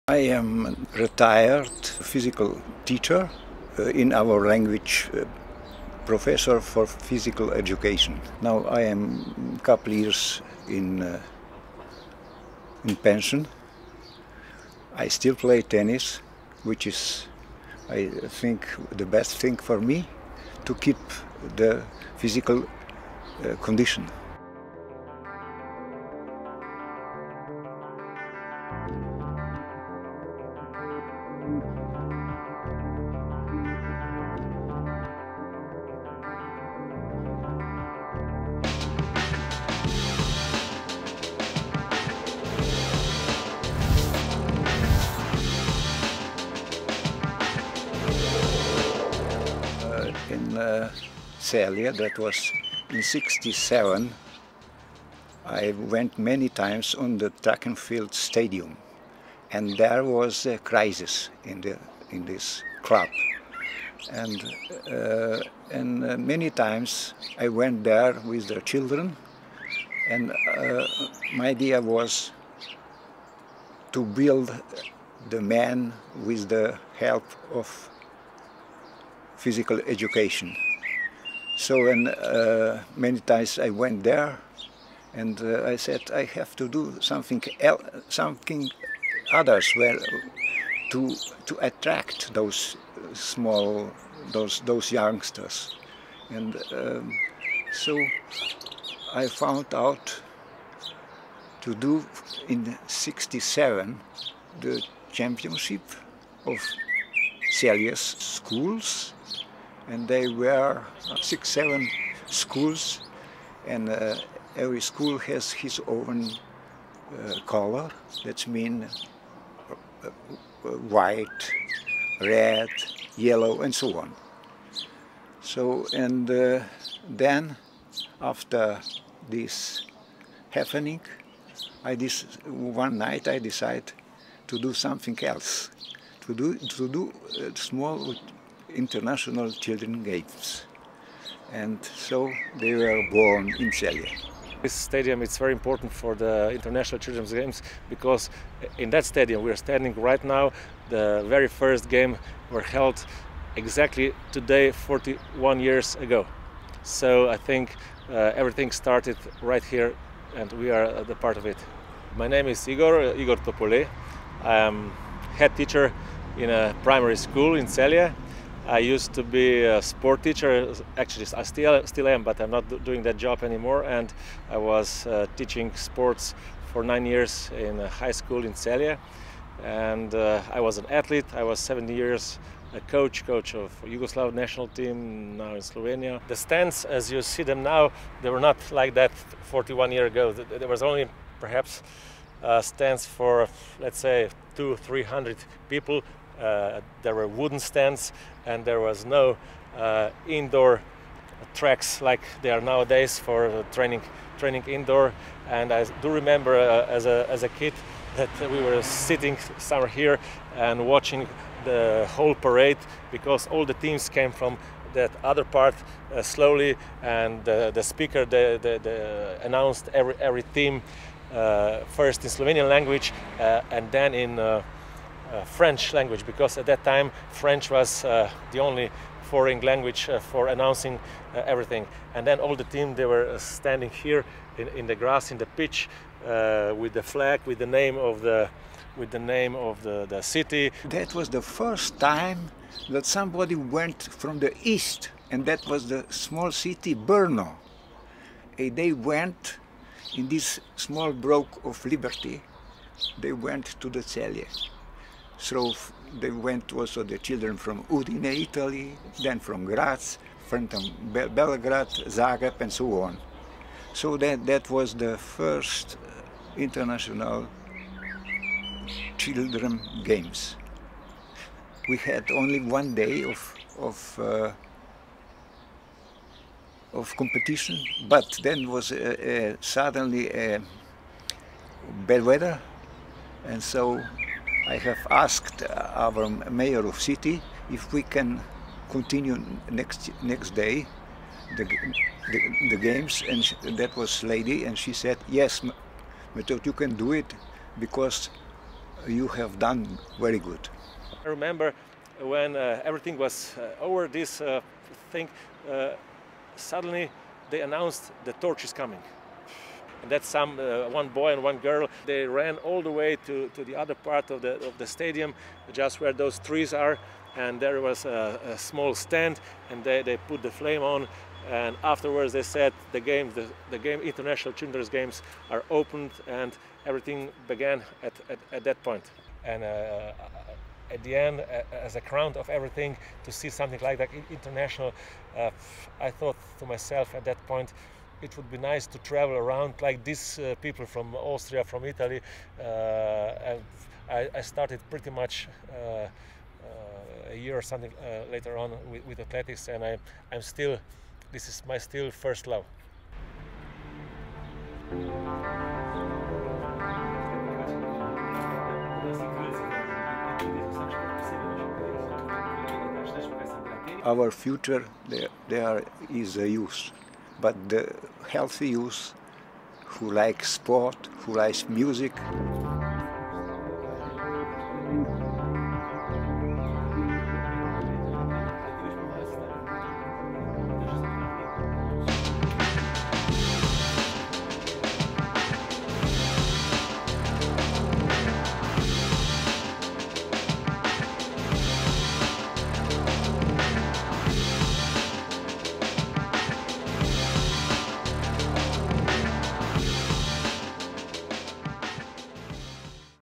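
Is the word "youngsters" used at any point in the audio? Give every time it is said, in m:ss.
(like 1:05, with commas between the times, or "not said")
1:34.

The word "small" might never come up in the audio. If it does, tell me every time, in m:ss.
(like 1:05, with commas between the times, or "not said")
1:33, 2:17, 4:06, 4:10, 5:18.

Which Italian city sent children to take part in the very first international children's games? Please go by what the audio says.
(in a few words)
Udine.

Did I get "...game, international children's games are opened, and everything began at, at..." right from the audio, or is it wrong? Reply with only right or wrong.
right.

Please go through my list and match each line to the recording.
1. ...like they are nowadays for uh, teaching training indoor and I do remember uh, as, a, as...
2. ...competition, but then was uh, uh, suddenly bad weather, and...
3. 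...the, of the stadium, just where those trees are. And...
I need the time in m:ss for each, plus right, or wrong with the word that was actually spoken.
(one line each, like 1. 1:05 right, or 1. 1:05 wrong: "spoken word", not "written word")
1. 3:22 wrong: "training", not "teaching"
2. 4:37 right
3. 5:14 right.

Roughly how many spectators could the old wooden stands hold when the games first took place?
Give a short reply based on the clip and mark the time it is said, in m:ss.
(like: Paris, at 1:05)
200 to 300, at 3:14.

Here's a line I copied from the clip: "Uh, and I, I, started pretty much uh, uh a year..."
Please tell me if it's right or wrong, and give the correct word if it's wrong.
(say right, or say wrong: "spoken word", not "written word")
right.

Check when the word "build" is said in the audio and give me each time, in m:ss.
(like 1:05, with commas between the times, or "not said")
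1:14.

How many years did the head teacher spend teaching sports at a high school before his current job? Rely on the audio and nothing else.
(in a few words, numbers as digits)
9.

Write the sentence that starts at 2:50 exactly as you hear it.
Actually, I still still am, but I'm not doing that job anymore.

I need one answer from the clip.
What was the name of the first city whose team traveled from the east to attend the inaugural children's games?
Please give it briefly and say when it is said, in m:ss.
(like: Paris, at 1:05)
Brno, at 4:06.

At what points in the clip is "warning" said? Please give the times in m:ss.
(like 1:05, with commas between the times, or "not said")
not said.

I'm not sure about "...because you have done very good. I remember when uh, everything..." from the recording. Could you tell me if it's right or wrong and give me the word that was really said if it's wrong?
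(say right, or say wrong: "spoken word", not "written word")
right.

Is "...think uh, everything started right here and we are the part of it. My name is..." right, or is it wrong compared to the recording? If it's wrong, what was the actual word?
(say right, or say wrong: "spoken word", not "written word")
right.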